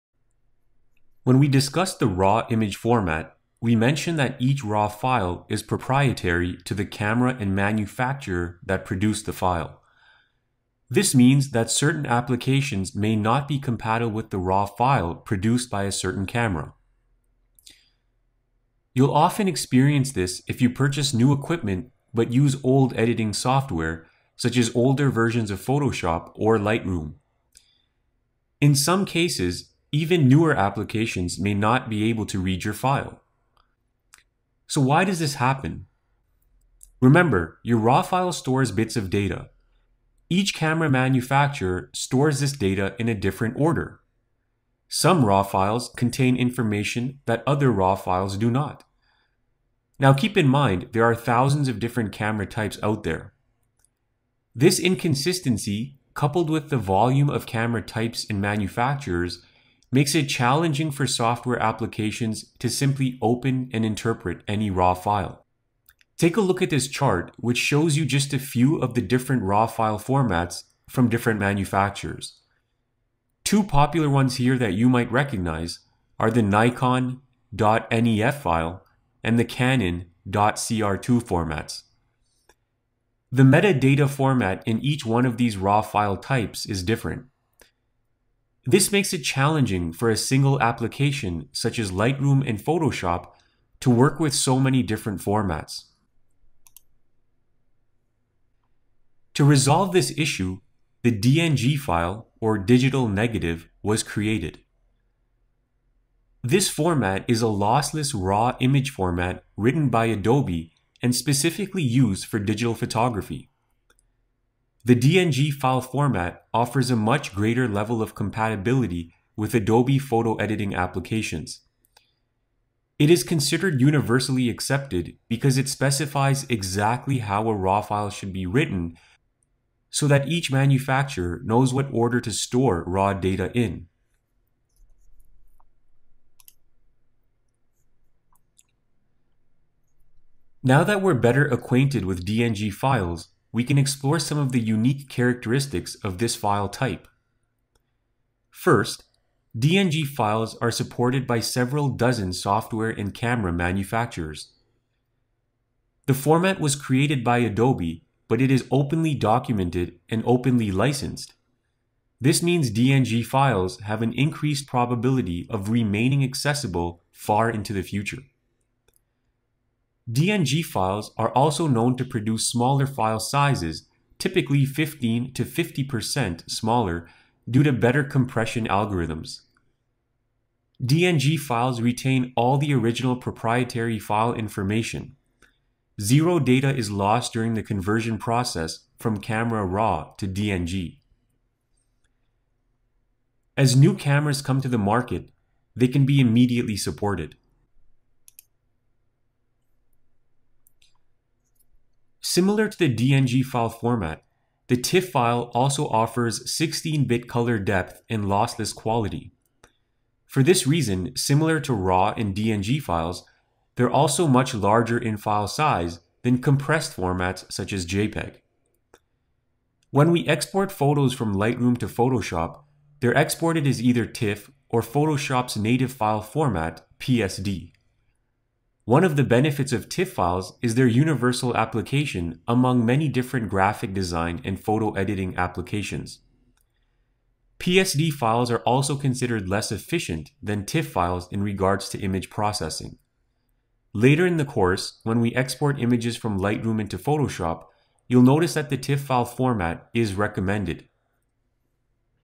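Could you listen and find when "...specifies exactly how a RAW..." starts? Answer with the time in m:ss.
2:05.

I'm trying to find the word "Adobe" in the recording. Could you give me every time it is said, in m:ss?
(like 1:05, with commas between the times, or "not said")
1:50, 1:59, 2:37.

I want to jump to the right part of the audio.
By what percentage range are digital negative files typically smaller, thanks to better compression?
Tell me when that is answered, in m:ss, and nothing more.
2:54.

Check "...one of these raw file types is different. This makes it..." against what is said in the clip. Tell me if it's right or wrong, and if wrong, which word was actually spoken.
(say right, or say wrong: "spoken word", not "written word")
right.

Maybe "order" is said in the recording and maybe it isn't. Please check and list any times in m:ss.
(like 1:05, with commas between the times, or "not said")
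0:43, 2:11.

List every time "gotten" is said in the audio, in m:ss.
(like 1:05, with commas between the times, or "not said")
not said.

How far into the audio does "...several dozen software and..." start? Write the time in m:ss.
2:31.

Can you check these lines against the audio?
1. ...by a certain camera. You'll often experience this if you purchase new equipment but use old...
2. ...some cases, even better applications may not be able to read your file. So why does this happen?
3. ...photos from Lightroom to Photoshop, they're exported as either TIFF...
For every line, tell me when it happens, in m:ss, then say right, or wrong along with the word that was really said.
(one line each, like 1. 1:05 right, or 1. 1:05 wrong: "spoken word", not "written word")
1. 0:15 right
2. 0:28 wrong: "newer", not "better"
3. 3:40 right.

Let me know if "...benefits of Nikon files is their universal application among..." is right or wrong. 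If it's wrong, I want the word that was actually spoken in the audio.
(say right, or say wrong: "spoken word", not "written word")
wrong: "TIFF", not "Nikon".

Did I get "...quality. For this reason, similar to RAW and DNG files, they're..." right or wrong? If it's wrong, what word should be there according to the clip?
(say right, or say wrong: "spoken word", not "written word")
right.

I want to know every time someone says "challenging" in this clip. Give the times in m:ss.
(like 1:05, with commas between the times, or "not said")
1:00, 1:29.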